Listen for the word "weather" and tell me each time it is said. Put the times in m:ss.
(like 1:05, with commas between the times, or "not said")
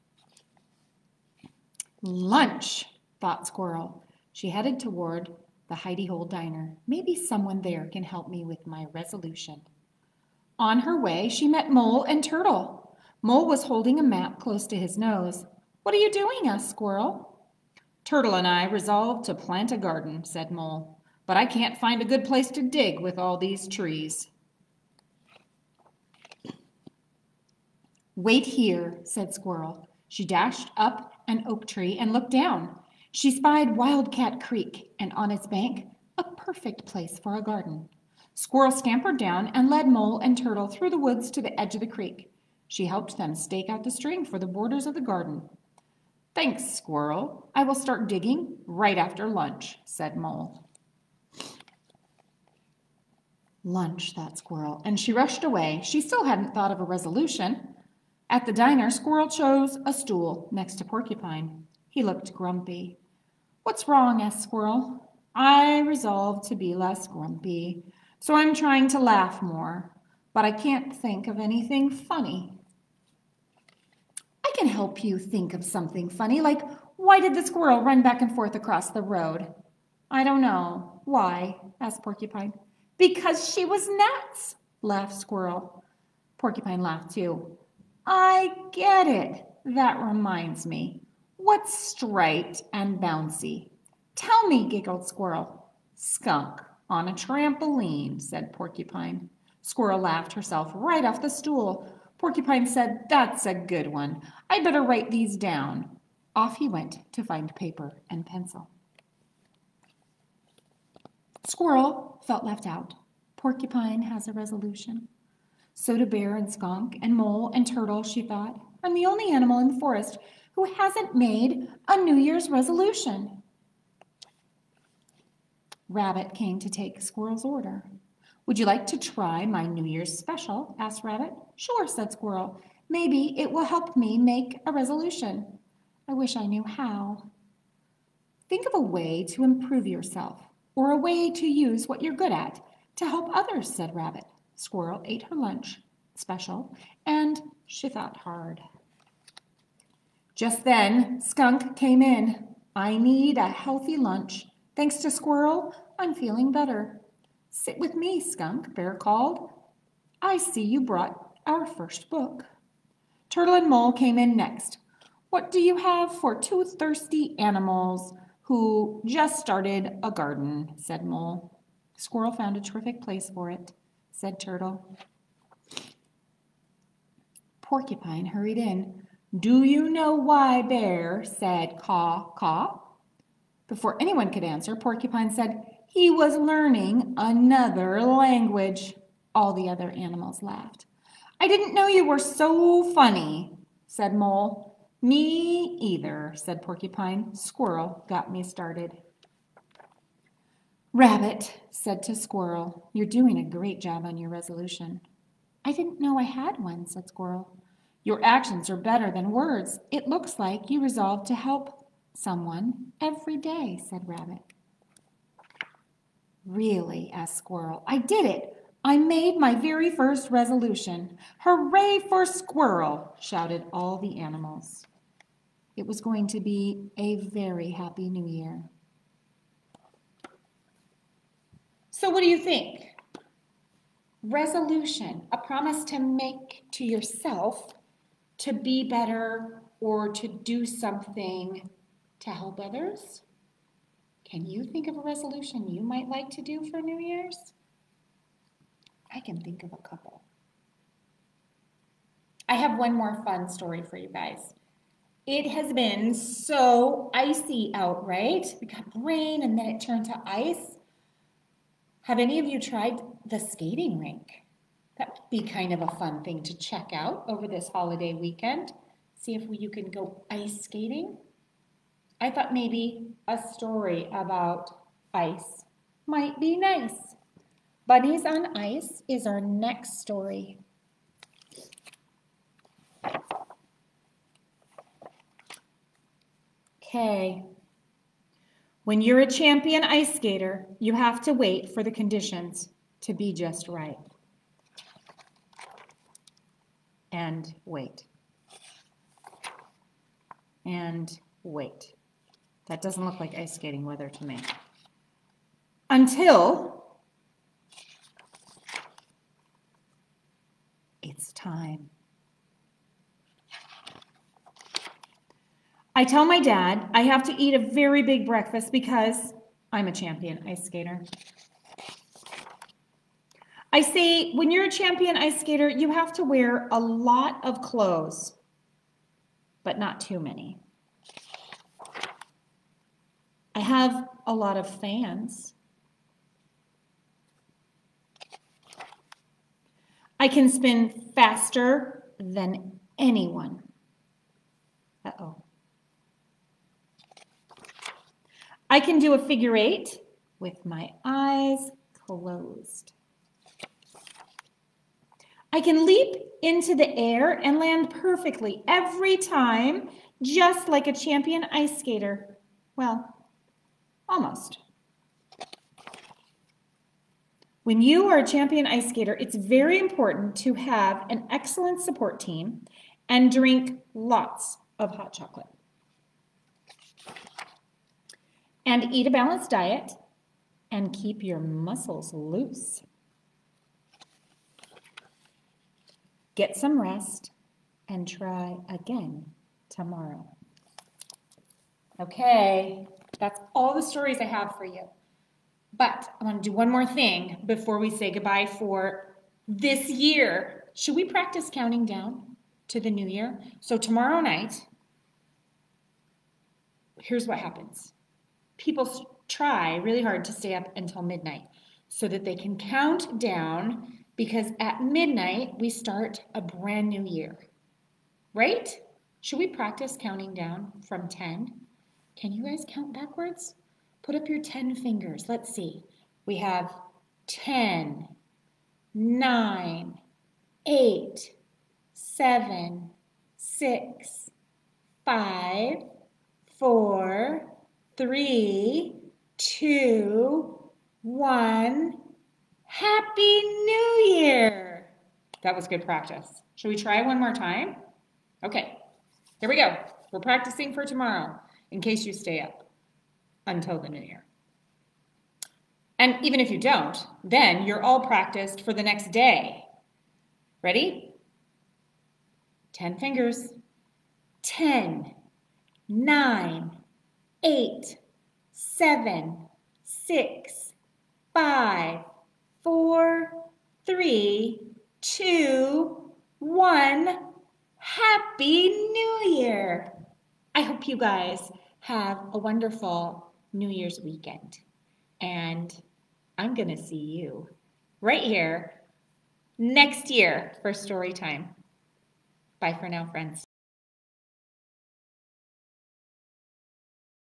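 5:03.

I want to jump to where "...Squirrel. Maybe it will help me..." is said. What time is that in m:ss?
2:12.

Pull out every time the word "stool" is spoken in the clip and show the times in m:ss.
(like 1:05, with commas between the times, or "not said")
0:59, 1:41.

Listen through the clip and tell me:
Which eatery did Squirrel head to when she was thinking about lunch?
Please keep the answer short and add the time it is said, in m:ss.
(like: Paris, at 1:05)
Hidey Hole Diner, at 0:05.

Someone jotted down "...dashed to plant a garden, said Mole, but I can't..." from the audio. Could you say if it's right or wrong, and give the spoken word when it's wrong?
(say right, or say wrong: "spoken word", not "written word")
wrong: "resolved", not "dashed".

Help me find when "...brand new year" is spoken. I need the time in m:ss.
6:56.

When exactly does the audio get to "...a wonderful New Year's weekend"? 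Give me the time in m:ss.
8:02.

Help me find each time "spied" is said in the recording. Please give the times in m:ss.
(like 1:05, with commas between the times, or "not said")
0:33.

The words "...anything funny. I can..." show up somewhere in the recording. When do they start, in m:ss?
1:11.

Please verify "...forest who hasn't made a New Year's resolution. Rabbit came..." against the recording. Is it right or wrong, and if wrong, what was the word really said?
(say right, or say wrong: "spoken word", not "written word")
right.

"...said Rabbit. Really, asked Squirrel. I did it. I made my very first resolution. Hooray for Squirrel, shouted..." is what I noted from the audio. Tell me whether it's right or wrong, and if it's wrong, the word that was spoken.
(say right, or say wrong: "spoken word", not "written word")
right.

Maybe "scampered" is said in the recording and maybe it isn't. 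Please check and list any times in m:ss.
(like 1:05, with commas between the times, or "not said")
0:38.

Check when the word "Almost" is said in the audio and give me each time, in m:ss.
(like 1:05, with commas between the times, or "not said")
6:04.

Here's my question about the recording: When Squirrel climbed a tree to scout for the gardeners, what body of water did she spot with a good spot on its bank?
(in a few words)
Wildcat Creek.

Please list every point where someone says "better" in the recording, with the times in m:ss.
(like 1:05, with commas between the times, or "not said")
1:44, 2:36, 3:28, 3:58.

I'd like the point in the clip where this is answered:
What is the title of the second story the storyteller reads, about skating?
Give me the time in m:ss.
4:37.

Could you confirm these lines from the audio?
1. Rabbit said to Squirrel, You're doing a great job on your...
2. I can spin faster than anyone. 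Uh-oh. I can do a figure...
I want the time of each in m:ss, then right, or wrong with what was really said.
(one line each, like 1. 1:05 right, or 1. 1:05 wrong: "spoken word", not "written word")
1. 3:20 right
2. 5:40 right.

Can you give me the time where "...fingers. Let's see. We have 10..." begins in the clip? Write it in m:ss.
7:04.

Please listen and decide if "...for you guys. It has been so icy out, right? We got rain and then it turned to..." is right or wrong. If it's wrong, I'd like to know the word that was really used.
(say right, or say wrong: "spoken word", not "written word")
right.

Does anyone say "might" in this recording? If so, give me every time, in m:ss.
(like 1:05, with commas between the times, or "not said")
4:05, 4:36.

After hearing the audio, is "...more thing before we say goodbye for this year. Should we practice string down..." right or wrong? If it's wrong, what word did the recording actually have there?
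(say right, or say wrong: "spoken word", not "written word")
wrong: "counting", not "string".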